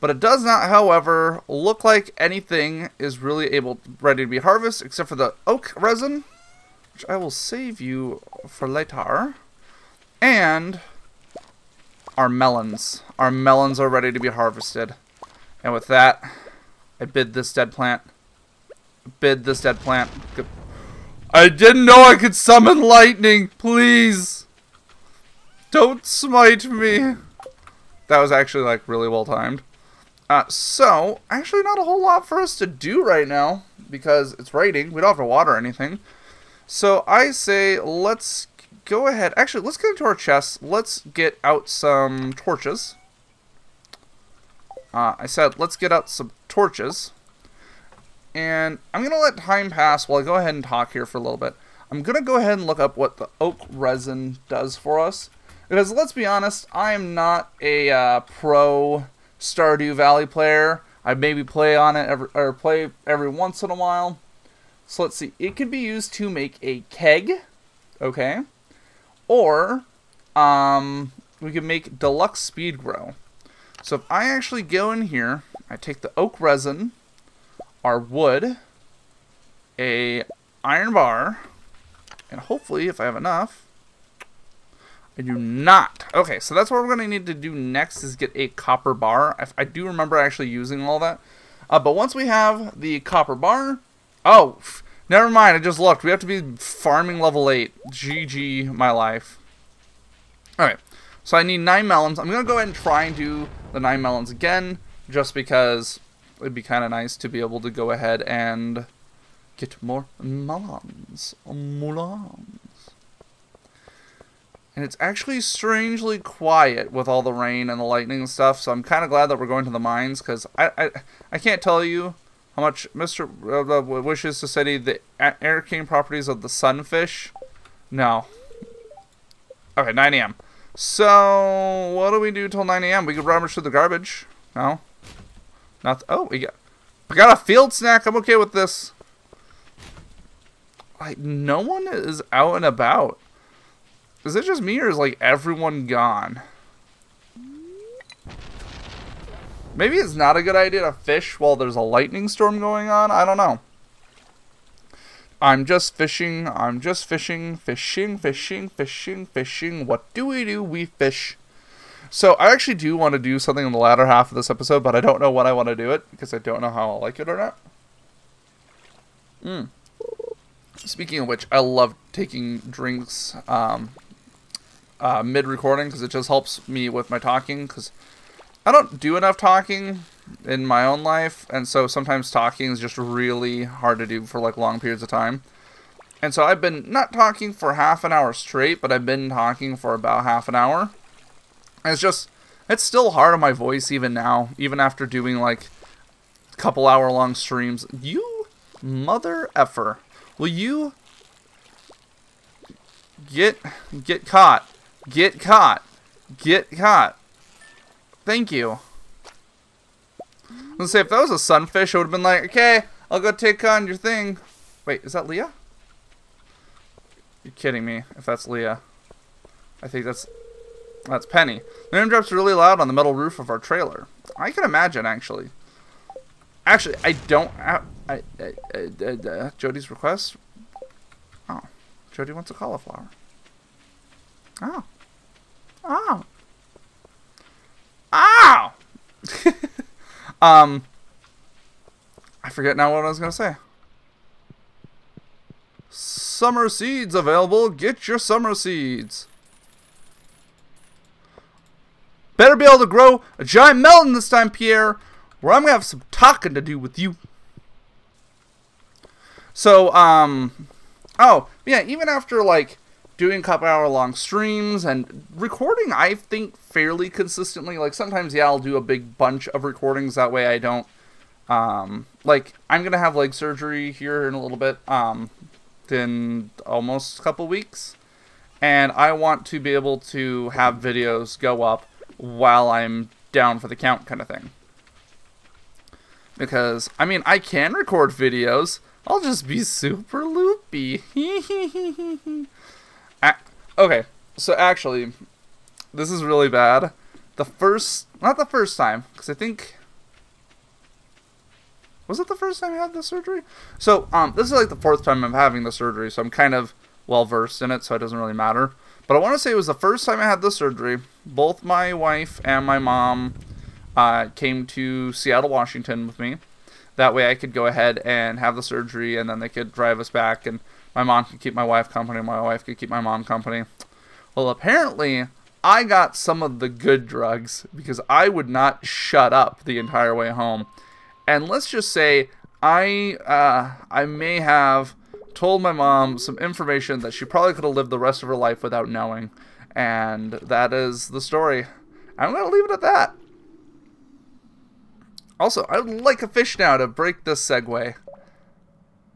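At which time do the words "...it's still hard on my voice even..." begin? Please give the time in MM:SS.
03:12.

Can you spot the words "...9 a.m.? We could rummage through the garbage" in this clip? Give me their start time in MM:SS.
02:12.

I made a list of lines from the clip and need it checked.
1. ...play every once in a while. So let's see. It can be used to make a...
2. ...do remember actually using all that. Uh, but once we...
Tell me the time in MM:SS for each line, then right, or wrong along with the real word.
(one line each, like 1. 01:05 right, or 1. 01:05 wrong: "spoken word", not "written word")
1. 01:02 right
2. 01:29 right.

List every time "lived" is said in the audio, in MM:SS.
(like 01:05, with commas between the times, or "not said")
05:37.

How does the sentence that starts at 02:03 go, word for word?
Uh, wishes to study the arcane properties of the sunfish.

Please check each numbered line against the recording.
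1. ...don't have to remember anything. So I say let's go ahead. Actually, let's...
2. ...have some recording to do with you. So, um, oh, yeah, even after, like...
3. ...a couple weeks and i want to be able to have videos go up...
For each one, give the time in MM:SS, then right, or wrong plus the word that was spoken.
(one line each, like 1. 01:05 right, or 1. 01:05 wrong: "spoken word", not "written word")
1. 00:35 wrong: "water", not "remember"
2. 04:15 wrong: "talking", not "recording"
3. 04:37 right.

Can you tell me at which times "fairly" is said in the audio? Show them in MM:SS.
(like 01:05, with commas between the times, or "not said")
04:26.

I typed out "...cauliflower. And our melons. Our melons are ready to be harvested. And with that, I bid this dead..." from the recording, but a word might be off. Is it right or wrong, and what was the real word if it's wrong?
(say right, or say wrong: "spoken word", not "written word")
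wrong: "later", not "cauliflower".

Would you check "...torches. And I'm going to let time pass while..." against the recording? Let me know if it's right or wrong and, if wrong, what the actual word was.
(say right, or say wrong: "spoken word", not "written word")
right.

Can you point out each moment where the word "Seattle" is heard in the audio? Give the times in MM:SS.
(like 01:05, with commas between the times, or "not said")
05:15.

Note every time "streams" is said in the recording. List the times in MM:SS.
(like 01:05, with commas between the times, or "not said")
03:17, 04:24.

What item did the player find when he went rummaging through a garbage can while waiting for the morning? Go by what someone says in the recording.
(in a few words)
Field snack.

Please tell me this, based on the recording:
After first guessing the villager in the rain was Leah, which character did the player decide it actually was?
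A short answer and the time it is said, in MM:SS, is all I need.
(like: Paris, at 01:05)
Penny, at 03:41.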